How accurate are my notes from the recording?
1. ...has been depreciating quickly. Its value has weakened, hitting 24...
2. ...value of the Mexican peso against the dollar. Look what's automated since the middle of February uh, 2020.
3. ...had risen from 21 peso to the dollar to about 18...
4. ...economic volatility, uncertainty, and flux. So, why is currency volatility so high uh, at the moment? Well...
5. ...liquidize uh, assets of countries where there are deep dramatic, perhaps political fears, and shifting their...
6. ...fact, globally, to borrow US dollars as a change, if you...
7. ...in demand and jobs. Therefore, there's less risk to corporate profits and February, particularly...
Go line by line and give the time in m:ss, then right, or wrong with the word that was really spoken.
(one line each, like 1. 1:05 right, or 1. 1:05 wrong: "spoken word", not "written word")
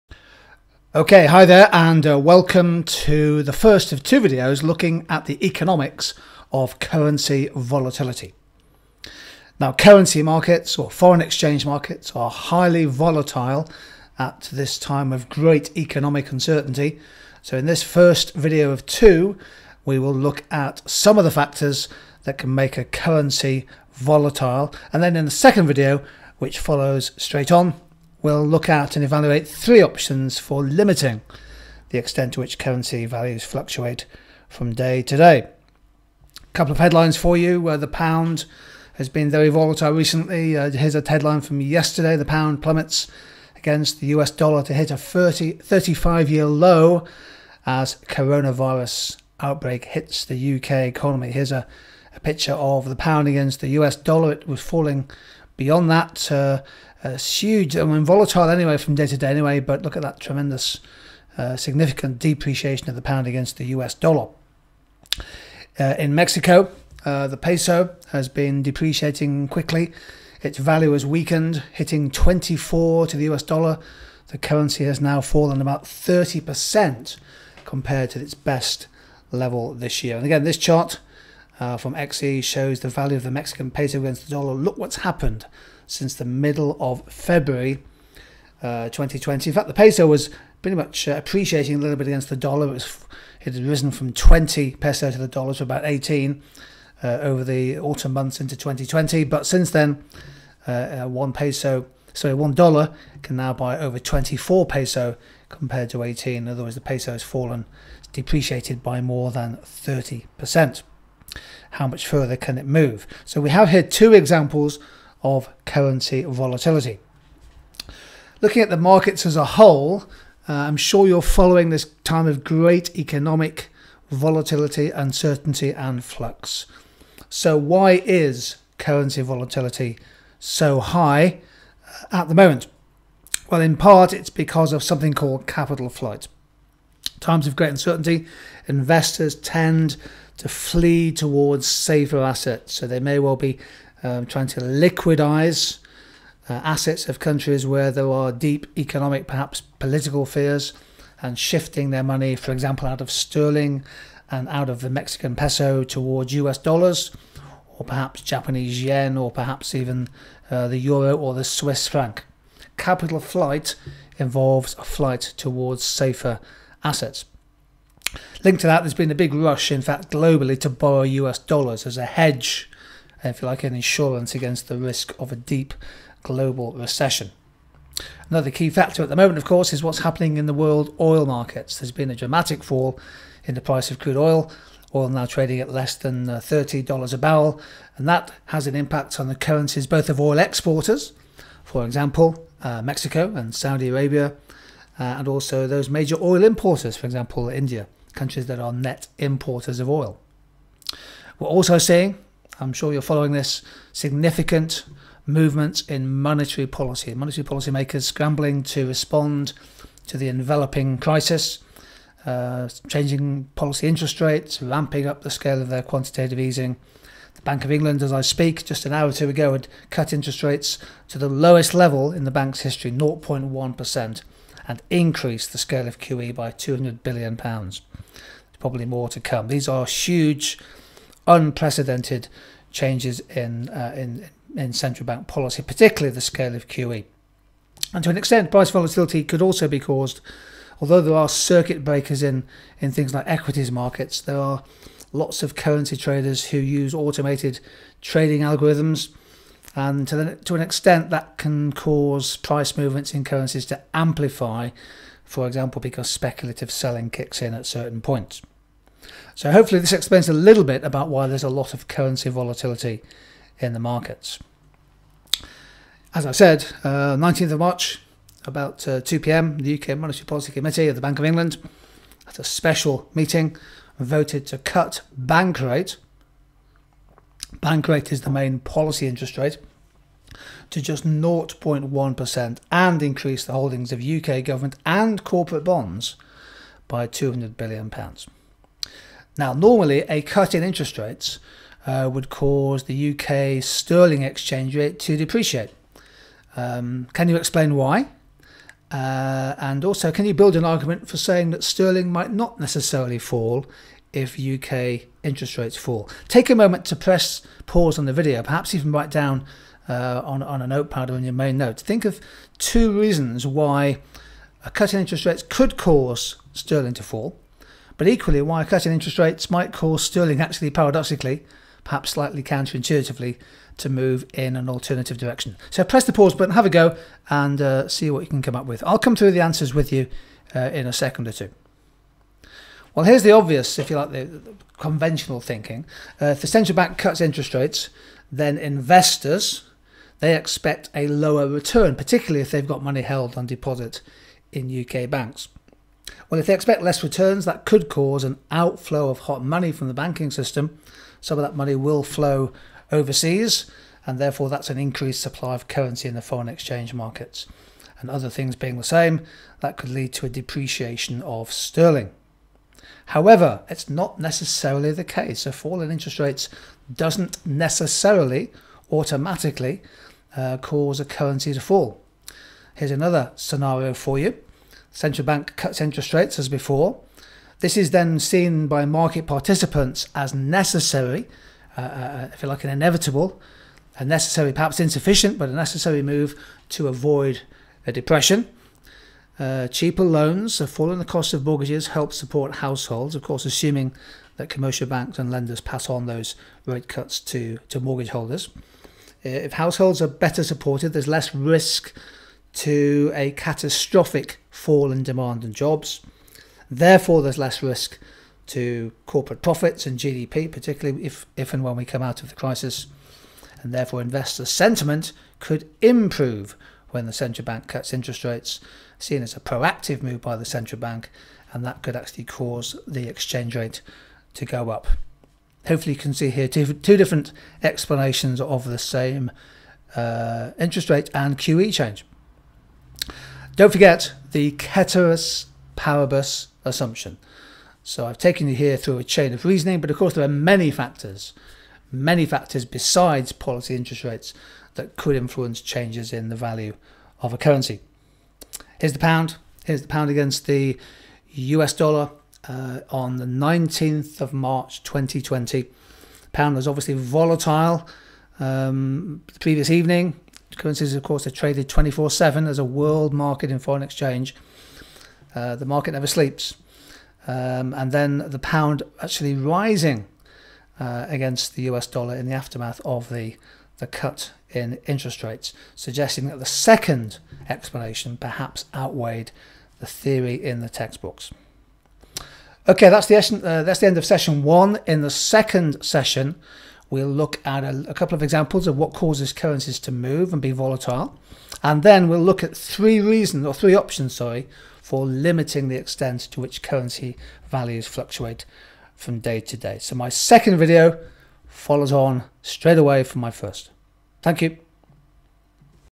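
1. 1:08 right
2. 1:22 wrong: "happened", not "automated"
3. 1:33 wrong: "20", not "21"
4. 2:02 right
5. 2:24 wrong: "economic", not "dramatic"
6. 2:49 wrong: "hedge", not "change"
7. 6:44 wrong: "GDP", not "February".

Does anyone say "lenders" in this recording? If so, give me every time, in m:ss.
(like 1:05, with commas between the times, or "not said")
6:35.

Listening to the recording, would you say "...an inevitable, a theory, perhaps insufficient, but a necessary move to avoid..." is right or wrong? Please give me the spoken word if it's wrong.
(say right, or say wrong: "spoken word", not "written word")
wrong: "necessary", not "theory".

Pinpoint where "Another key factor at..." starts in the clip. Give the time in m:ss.
2:58.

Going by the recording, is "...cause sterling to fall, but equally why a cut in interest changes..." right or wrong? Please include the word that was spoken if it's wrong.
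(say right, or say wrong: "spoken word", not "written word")
wrong: "rates", not "changes".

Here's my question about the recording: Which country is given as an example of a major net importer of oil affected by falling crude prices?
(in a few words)
India.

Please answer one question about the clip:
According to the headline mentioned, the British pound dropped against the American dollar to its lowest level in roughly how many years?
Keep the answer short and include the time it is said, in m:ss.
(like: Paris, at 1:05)
35, at 0:45.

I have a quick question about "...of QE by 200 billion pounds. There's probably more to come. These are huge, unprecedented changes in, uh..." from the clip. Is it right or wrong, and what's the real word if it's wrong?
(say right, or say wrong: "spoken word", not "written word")
right.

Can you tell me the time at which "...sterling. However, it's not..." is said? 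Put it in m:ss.
6:01.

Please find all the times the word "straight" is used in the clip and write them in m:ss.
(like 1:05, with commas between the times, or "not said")
0:27, 8:22.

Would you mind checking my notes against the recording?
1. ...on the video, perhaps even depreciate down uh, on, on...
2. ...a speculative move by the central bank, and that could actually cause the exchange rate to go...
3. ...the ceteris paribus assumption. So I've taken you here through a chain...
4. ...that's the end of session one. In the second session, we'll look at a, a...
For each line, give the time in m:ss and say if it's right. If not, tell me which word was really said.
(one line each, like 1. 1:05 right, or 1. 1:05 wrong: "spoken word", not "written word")
1. 5:07 wrong: "write", not "depreciate"
2. 6:59 wrong: "proactive", not "speculative"
3. 7:14 right
4. 8:03 right.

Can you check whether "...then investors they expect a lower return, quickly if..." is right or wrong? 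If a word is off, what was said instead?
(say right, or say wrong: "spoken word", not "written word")
wrong: "particularly", not "quickly".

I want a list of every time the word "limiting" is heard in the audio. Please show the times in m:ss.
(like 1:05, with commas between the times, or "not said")
0:30, 8:15.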